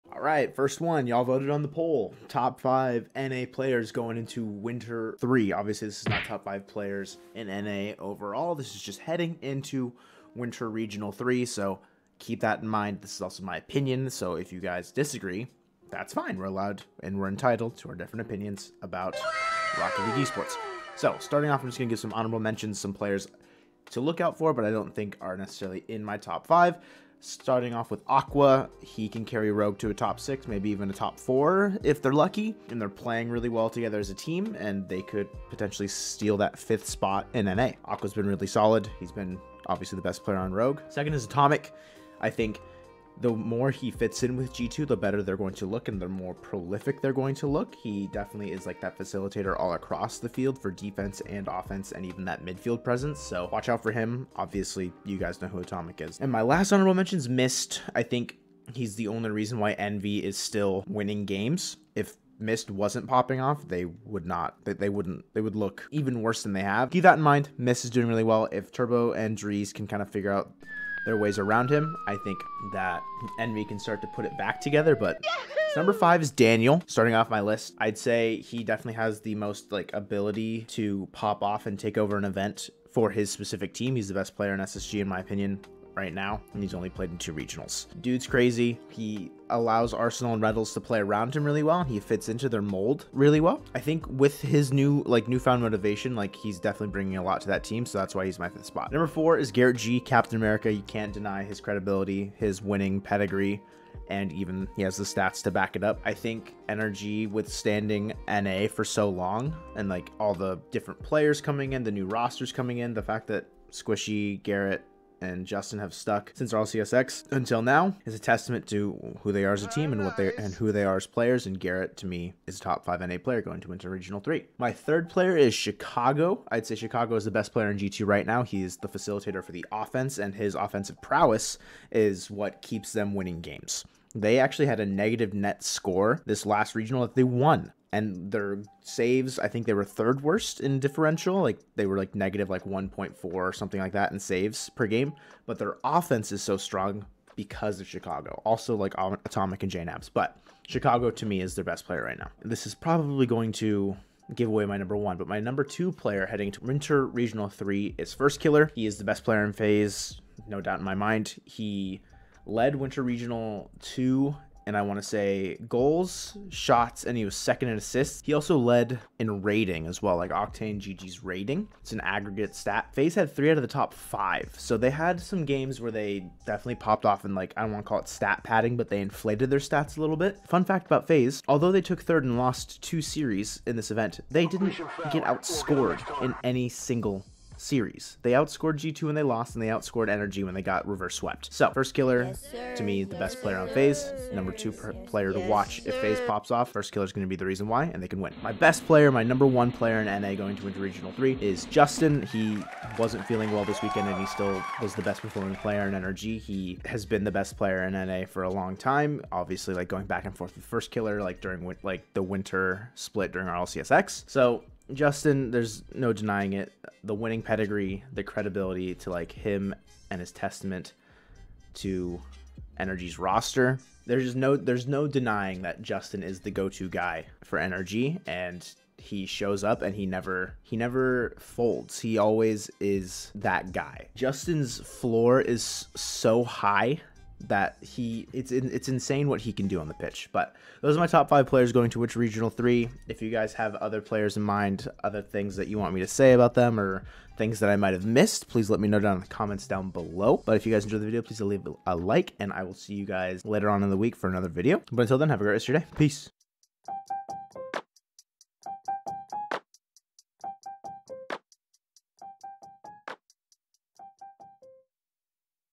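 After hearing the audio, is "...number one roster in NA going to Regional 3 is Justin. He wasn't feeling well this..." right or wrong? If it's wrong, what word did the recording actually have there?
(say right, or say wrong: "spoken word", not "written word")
wrong: "player", not "roster".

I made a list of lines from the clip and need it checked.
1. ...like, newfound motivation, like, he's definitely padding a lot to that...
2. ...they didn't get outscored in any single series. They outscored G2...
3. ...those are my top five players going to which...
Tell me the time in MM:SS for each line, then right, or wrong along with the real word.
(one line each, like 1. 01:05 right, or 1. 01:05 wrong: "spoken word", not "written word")
1. 01:35 wrong: "bringing", not "padding"
2. 03:04 right
3. 04:00 right.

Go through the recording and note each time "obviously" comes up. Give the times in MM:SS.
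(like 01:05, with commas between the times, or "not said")
00:05, 00:39, 00:54, 03:29.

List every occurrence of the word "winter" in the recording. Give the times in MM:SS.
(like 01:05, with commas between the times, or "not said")
00:04, 00:10, 02:36, 02:42, 03:32.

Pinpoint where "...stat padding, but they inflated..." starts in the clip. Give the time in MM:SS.
02:58.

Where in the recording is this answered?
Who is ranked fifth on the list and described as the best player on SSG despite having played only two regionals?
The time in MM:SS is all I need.
01:16.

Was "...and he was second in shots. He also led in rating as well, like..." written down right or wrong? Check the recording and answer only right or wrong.
wrong.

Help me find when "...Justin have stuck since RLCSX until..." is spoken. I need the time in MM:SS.
01:55.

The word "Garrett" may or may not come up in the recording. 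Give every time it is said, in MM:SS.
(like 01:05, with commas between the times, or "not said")
01:39, 01:54, 02:01.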